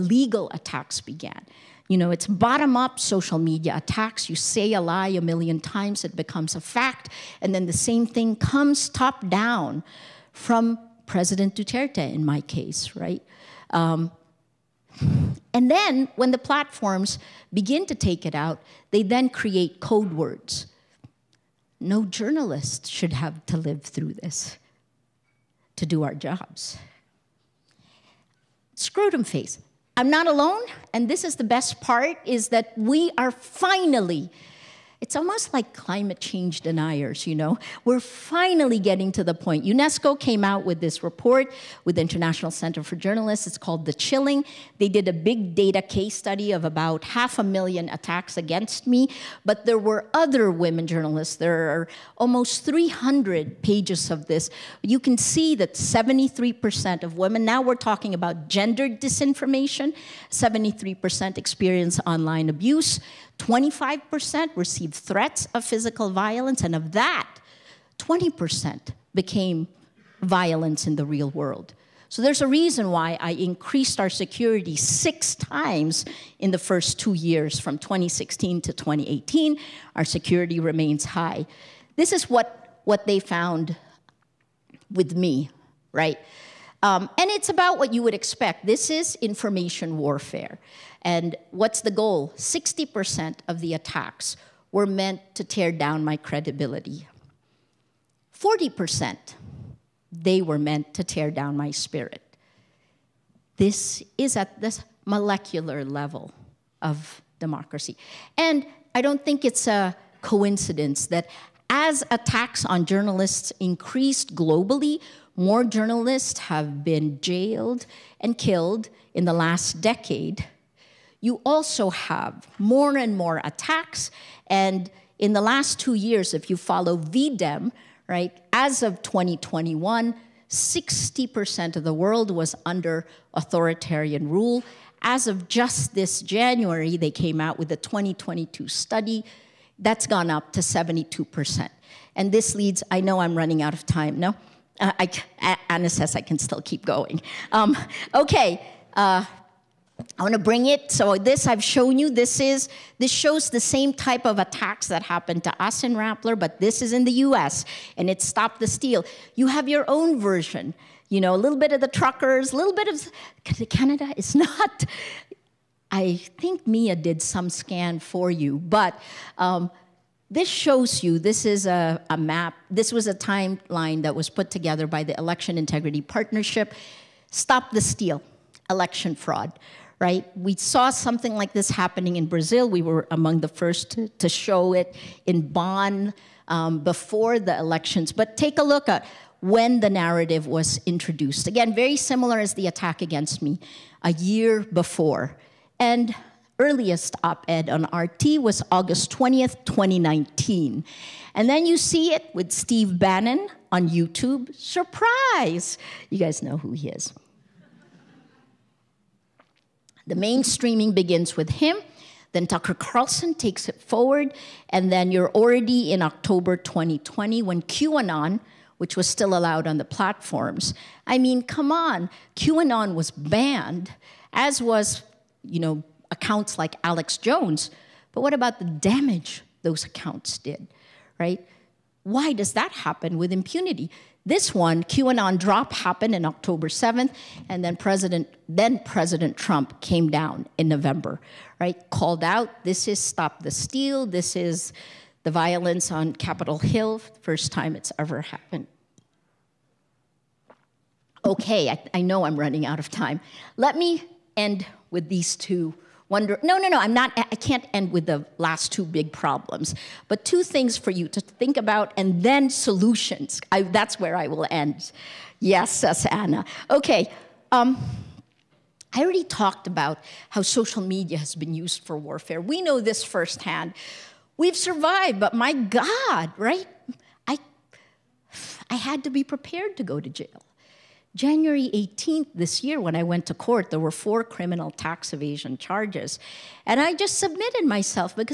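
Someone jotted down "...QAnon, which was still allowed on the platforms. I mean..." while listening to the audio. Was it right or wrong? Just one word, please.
right.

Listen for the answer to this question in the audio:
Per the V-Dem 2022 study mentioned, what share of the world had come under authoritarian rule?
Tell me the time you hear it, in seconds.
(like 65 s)
140 s.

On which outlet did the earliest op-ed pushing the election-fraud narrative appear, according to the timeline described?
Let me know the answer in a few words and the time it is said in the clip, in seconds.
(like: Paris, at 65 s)
RT, at 197 s.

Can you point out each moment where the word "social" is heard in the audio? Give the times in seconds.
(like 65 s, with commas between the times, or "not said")
3 s, 270 s.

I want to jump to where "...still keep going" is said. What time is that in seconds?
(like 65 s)
146 s.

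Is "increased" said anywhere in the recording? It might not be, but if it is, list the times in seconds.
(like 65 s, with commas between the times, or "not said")
73 s, 113 s.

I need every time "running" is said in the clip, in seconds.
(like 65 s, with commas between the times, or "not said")
143 s, 252 s.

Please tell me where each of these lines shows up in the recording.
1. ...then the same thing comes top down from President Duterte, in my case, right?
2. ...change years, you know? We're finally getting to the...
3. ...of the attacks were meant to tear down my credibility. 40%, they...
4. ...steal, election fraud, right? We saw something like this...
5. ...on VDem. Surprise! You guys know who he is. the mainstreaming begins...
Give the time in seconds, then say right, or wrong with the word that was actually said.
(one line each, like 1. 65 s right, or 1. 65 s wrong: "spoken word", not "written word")
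1. 7 s right
2. 36 s wrong: "deniers", not "years"
3. 93 s right
4. 177 s right
5. 203 s wrong: "YouTube", not "VDem".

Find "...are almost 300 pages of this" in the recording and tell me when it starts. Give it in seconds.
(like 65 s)
51 s.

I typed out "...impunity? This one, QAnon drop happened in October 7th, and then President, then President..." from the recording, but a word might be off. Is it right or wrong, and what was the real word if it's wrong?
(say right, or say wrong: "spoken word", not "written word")
right.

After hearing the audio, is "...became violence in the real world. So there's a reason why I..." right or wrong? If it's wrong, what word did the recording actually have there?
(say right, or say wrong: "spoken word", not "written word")
right.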